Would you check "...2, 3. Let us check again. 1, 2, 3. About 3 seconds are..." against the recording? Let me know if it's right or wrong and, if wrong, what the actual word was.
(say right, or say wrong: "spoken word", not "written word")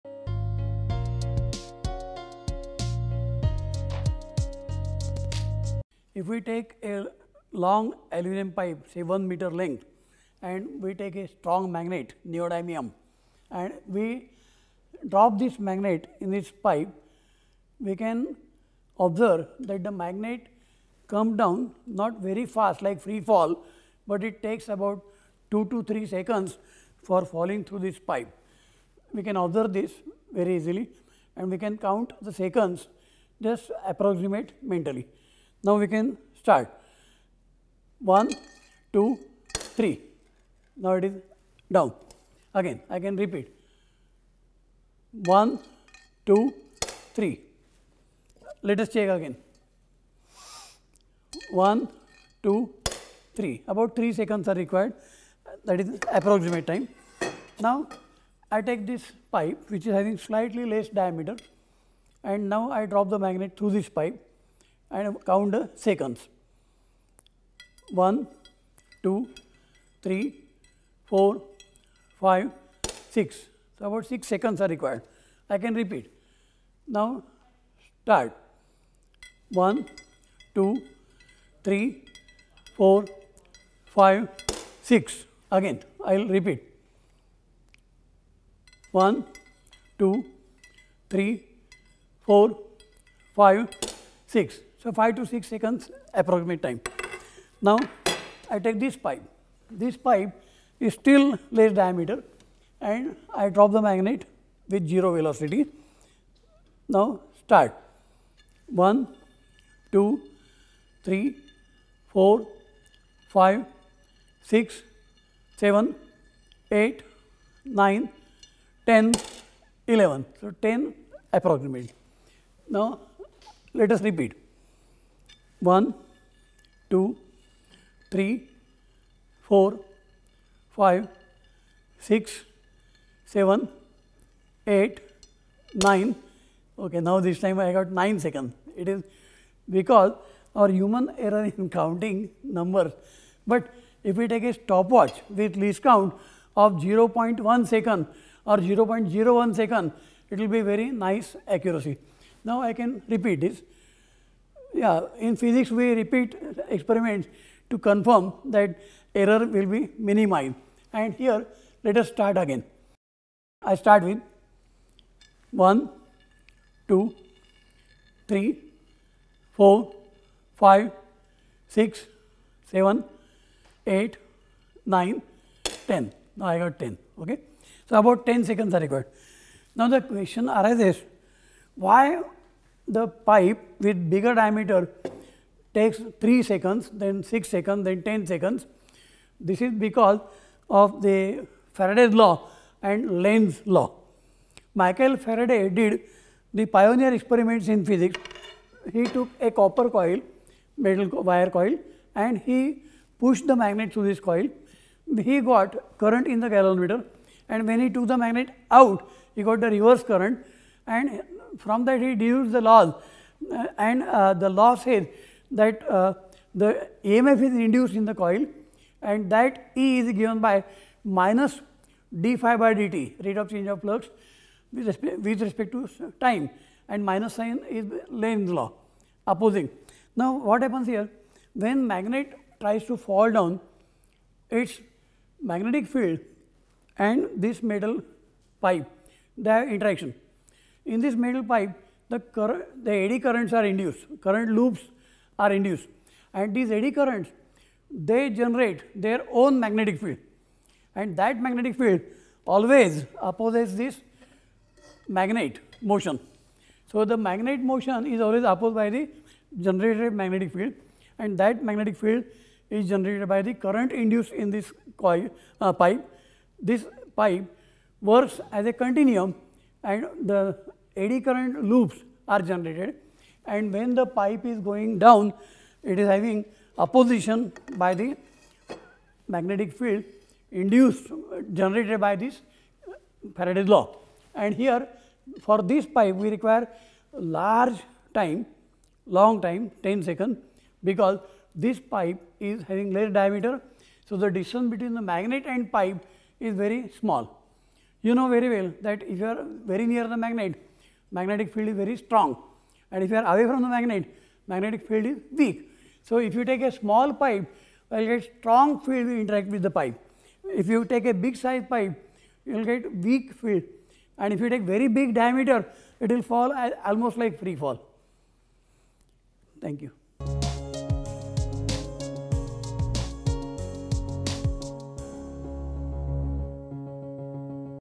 right.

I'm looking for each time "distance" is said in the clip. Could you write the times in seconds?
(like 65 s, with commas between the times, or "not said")
294 s.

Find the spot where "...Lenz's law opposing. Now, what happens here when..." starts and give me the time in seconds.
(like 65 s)
228 s.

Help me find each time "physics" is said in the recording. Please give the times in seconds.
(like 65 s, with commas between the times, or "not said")
155 s, 197 s.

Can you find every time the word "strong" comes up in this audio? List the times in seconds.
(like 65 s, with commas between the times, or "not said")
11 s, 301 s, 308 s.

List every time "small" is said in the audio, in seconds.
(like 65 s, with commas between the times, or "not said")
296 s, 306 s.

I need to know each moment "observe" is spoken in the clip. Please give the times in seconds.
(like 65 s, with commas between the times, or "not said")
18 s, 29 s.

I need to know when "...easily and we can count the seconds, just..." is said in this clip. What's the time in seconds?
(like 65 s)
30 s.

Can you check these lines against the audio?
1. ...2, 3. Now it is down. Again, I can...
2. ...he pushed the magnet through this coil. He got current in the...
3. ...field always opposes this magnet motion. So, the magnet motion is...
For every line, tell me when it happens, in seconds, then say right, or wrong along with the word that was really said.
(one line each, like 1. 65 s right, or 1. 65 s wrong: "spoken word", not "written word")
1. 38 s right
2. 202 s right
3. 251 s right.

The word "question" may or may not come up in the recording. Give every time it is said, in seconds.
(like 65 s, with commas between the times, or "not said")
180 s.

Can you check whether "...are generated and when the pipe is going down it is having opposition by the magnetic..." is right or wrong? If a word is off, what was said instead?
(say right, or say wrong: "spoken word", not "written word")
right.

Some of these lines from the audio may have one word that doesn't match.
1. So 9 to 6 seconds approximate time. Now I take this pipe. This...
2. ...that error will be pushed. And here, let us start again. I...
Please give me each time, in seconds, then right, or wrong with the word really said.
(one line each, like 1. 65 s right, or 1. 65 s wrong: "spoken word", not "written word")
1. 94 s wrong: "5", not "9"
2. 158 s wrong: "minimized", not "pushed".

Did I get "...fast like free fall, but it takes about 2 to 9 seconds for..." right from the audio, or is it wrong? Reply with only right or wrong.
wrong.